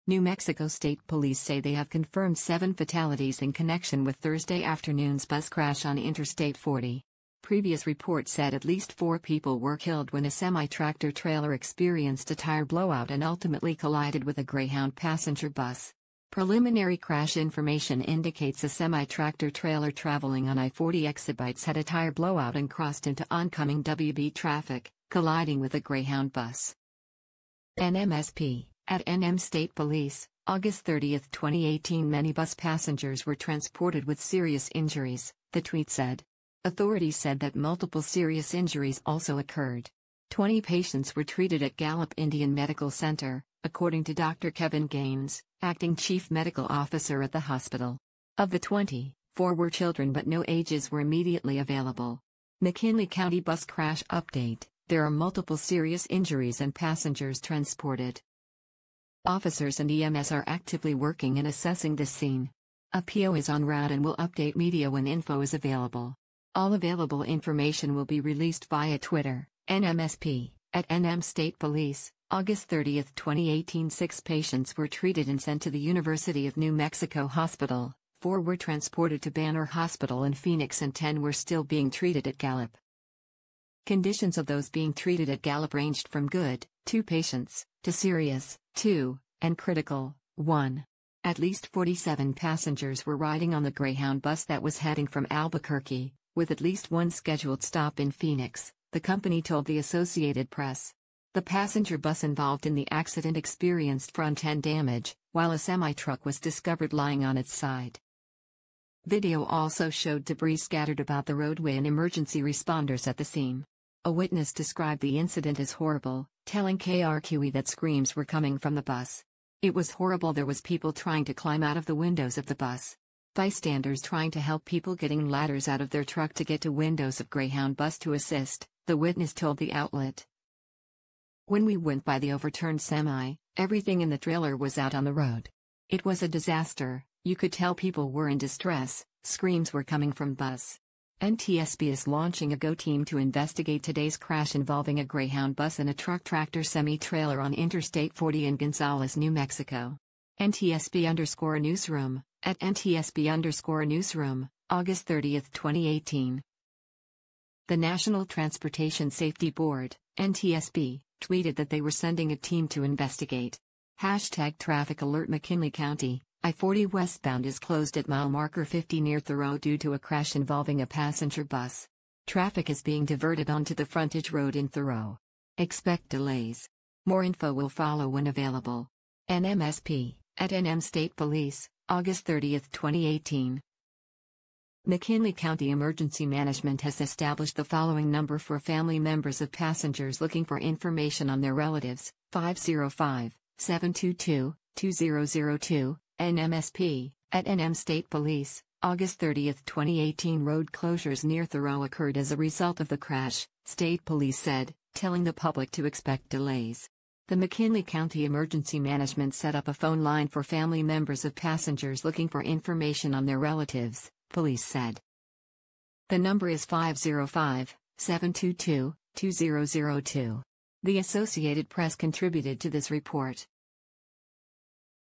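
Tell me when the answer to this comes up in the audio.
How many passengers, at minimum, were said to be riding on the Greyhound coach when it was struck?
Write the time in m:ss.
1:31.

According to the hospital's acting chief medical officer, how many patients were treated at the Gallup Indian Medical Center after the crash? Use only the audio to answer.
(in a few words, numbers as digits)
20.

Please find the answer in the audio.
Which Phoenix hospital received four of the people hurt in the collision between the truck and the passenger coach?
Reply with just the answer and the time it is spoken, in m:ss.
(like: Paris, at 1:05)
Banner Hospital, at 1:19.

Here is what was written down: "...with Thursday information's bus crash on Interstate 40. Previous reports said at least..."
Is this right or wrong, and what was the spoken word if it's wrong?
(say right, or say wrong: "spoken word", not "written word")
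wrong: "afternoon", not "information".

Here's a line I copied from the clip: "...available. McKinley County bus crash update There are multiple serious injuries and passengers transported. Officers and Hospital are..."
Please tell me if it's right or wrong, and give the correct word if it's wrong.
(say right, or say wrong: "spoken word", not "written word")
wrong: "EMS", not "Hospital".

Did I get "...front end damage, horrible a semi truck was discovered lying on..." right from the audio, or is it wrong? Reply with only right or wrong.
wrong.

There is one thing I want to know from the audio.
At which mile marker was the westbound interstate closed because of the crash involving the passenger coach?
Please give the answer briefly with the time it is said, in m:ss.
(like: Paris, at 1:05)
50, at 2:48.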